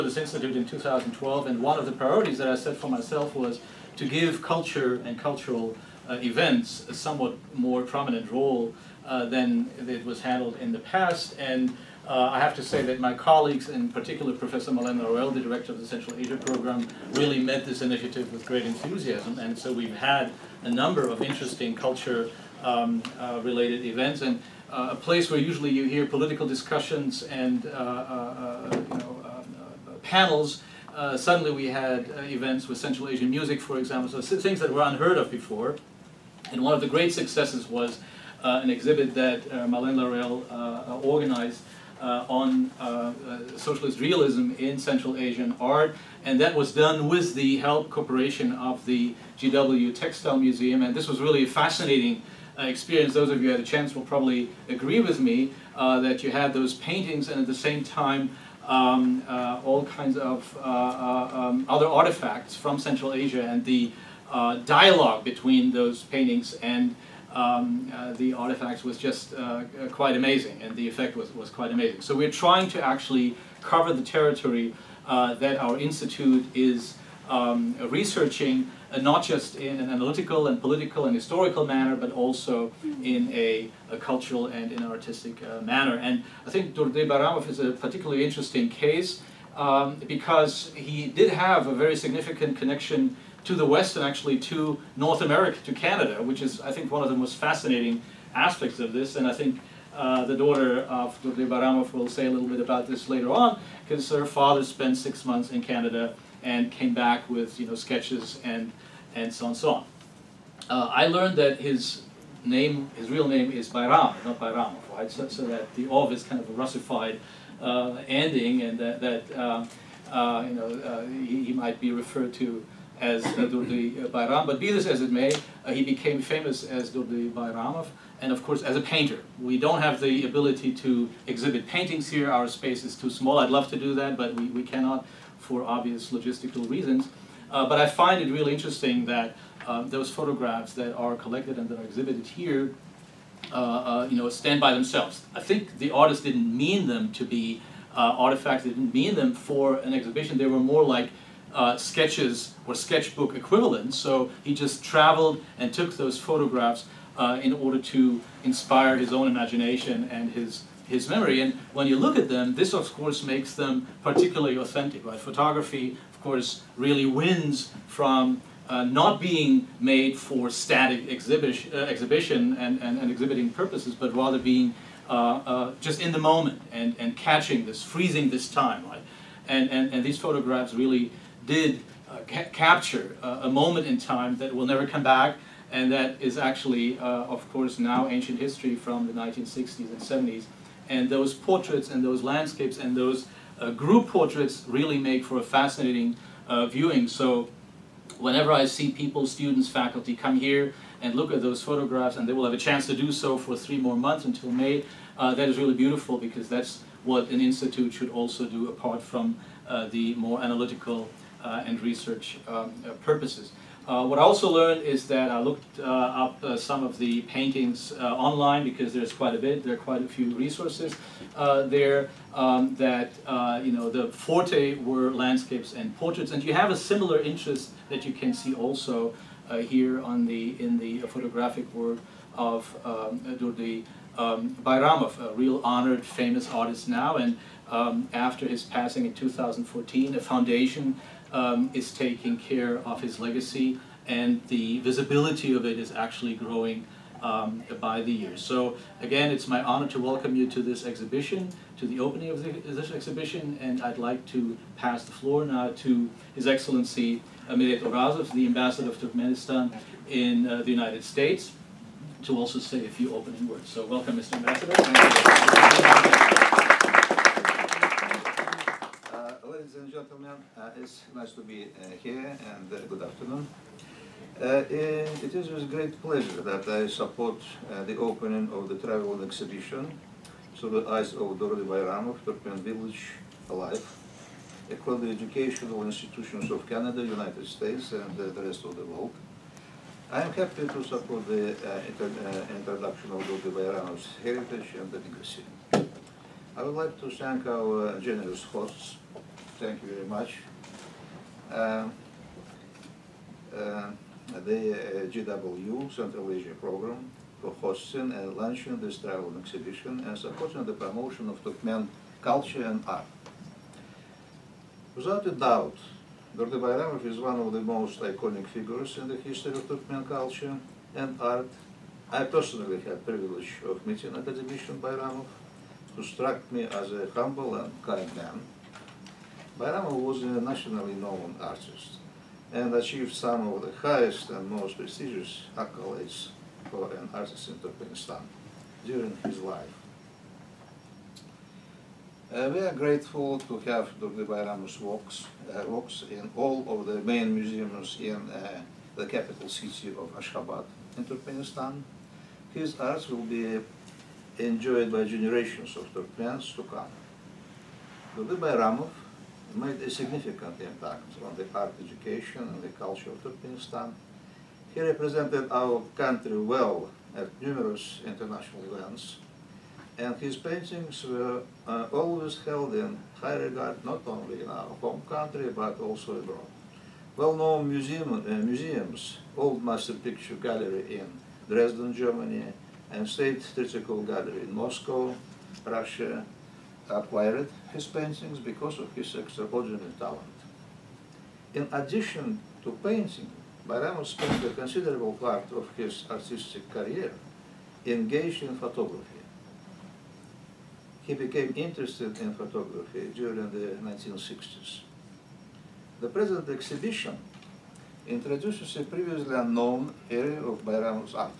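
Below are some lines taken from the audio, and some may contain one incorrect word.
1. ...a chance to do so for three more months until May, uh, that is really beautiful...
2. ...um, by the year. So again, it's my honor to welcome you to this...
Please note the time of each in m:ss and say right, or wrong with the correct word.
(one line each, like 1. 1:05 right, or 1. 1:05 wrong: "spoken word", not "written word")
1. 3:22 right
2. 4:07 right.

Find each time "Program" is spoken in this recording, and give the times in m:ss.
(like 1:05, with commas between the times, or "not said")
0:16, 5:06.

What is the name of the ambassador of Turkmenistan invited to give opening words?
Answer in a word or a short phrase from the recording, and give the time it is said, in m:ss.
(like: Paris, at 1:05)
Meret Orazov, at 4:17.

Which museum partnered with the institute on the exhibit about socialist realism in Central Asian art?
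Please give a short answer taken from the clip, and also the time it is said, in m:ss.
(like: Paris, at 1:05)
GW Textile Museum, at 0:49.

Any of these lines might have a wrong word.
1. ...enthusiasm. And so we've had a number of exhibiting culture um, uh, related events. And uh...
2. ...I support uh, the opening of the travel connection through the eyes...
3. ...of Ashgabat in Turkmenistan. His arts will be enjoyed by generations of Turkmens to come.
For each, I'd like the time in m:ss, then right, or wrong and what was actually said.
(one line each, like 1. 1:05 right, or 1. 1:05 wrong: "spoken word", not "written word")
1. 0:18 wrong: "interesting", not "exhibiting"
2. 4:36 wrong: "exhibition", not "connection"
3. 5:49 right.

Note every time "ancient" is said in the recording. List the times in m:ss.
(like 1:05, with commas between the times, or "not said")
3:08.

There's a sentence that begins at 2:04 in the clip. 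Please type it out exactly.
But be this as it may, uh, he became famous as Durdy Bayramov, and of course as a painter.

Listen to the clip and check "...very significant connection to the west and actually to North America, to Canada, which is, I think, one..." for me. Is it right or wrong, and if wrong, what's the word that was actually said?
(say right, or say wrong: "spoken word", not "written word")
right.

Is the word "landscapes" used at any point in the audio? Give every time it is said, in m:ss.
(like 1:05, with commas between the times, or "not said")
3:12, 3:45.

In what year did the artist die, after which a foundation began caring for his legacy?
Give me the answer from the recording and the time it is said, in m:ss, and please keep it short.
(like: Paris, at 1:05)
2014, at 3:59.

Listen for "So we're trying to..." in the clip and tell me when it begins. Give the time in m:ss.
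1:12.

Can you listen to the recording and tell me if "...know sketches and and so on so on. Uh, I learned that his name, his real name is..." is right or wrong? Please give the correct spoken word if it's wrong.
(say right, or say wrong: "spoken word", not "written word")
right.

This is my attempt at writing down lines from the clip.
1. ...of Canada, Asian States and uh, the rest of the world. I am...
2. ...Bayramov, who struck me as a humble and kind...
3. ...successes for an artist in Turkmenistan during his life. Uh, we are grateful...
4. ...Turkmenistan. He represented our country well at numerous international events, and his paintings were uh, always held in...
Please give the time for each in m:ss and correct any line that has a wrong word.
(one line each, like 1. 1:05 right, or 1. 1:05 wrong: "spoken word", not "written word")
1. 4:46 wrong: "United", not "Asian"
2. 5:24 right
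3. 5:35 wrong: "accolades", not "successes"
4. 6:03 right.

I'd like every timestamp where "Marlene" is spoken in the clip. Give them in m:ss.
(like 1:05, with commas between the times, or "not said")
0:14, 0:39.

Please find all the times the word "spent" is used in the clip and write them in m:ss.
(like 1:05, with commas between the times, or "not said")
1:44, 6:34.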